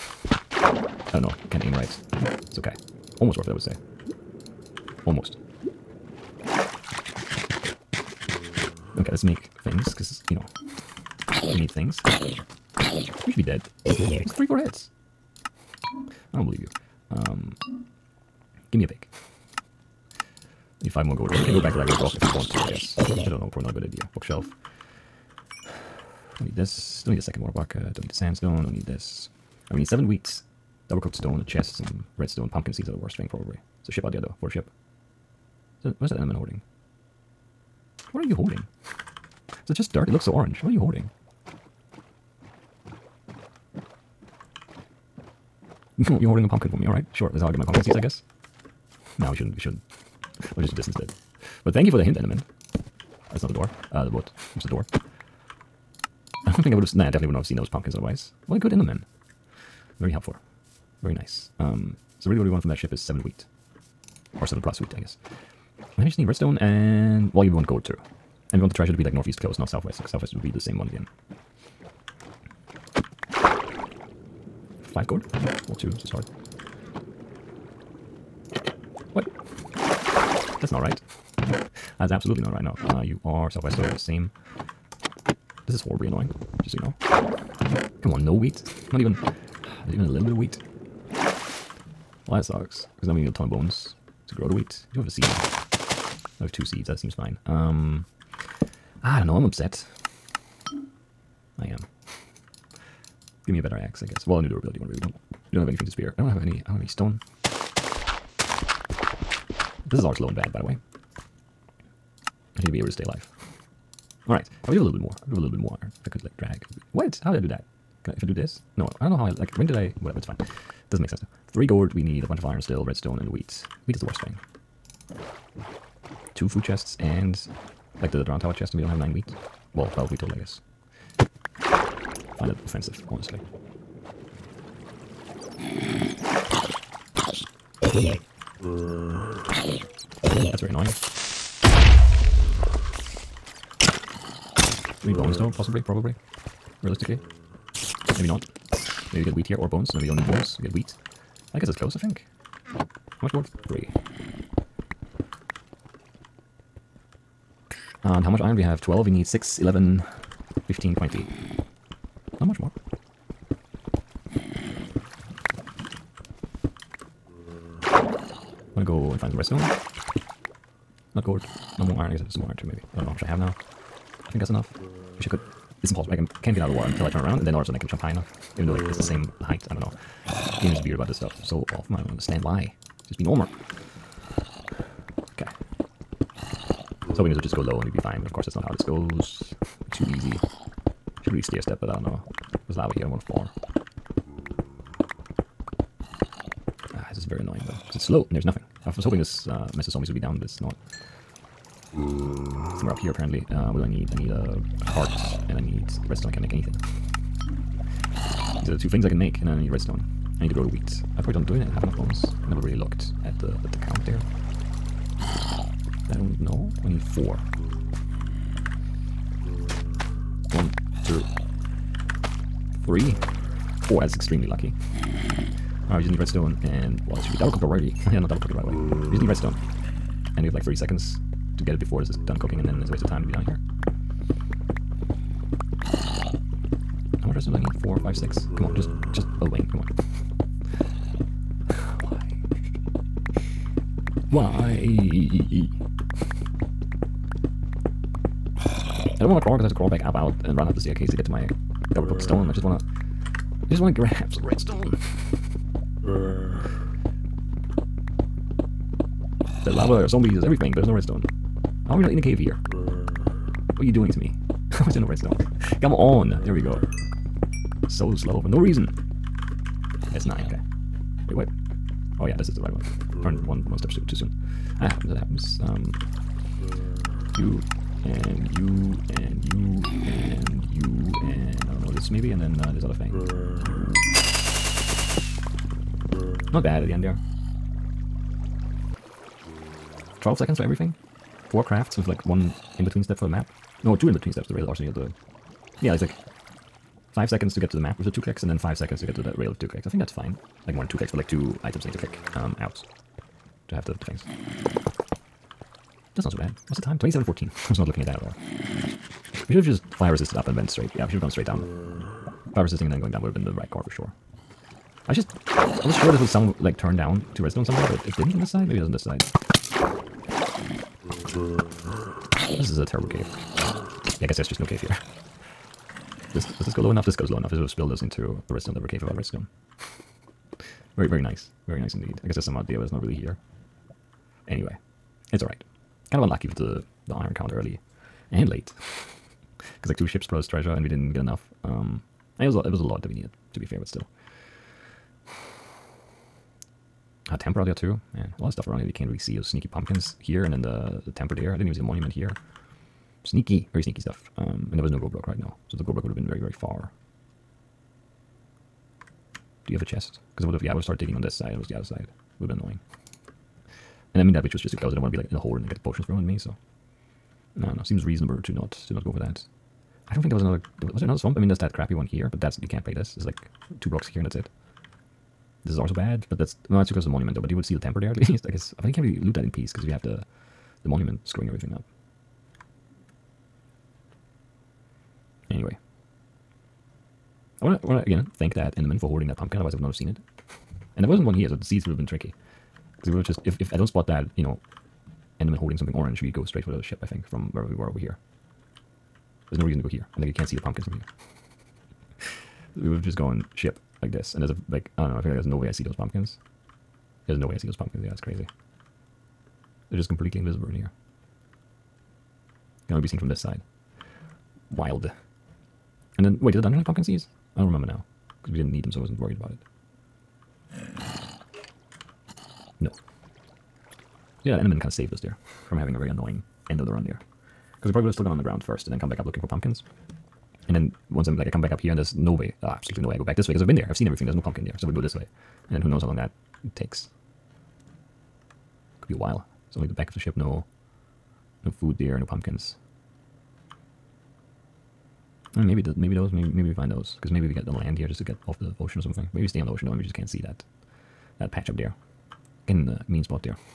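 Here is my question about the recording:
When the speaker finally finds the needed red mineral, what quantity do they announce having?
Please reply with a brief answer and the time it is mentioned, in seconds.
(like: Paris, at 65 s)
9, at 270 s.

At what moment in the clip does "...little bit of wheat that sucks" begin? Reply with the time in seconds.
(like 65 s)
90 s.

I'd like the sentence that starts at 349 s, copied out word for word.
Those sneaky pumpkins here and then the, the temple there.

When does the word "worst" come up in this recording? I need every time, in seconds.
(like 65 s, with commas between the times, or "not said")
32 s, 124 s.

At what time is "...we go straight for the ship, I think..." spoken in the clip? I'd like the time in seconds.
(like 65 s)
396 s.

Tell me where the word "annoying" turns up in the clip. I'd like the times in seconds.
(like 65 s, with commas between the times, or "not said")
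86 s, 140 s, 197 s, 362 s, 426 s.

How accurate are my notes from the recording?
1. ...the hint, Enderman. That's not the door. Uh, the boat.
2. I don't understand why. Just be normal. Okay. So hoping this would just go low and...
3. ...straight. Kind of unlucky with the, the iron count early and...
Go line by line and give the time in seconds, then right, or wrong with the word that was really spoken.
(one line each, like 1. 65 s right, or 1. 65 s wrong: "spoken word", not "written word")
1. 51 s right
2. 181 s right
3. 335 s wrong: "alright", not "straight".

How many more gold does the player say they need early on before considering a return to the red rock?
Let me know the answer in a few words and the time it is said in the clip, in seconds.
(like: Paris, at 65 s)
5, at 20 s.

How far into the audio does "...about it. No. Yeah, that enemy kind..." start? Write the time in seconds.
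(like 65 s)
419 s.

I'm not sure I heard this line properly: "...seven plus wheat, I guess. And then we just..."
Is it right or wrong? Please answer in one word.
right.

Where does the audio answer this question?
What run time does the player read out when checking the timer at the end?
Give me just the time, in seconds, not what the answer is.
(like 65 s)
306 s.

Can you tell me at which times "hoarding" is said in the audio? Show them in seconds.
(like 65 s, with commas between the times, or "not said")
36 s, 389 s.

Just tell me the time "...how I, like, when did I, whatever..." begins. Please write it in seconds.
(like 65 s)
119 s.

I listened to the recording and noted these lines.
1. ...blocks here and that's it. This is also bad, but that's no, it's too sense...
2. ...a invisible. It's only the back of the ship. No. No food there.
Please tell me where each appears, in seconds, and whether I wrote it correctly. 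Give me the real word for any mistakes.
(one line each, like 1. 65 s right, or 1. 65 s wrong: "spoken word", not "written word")
1. 373 s wrong: "close", not "sense"
2. 439 s wrong: "while", not "invisible".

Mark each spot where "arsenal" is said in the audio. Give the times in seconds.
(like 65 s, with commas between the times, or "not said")
294 s.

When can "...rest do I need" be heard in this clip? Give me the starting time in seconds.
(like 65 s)
237 s.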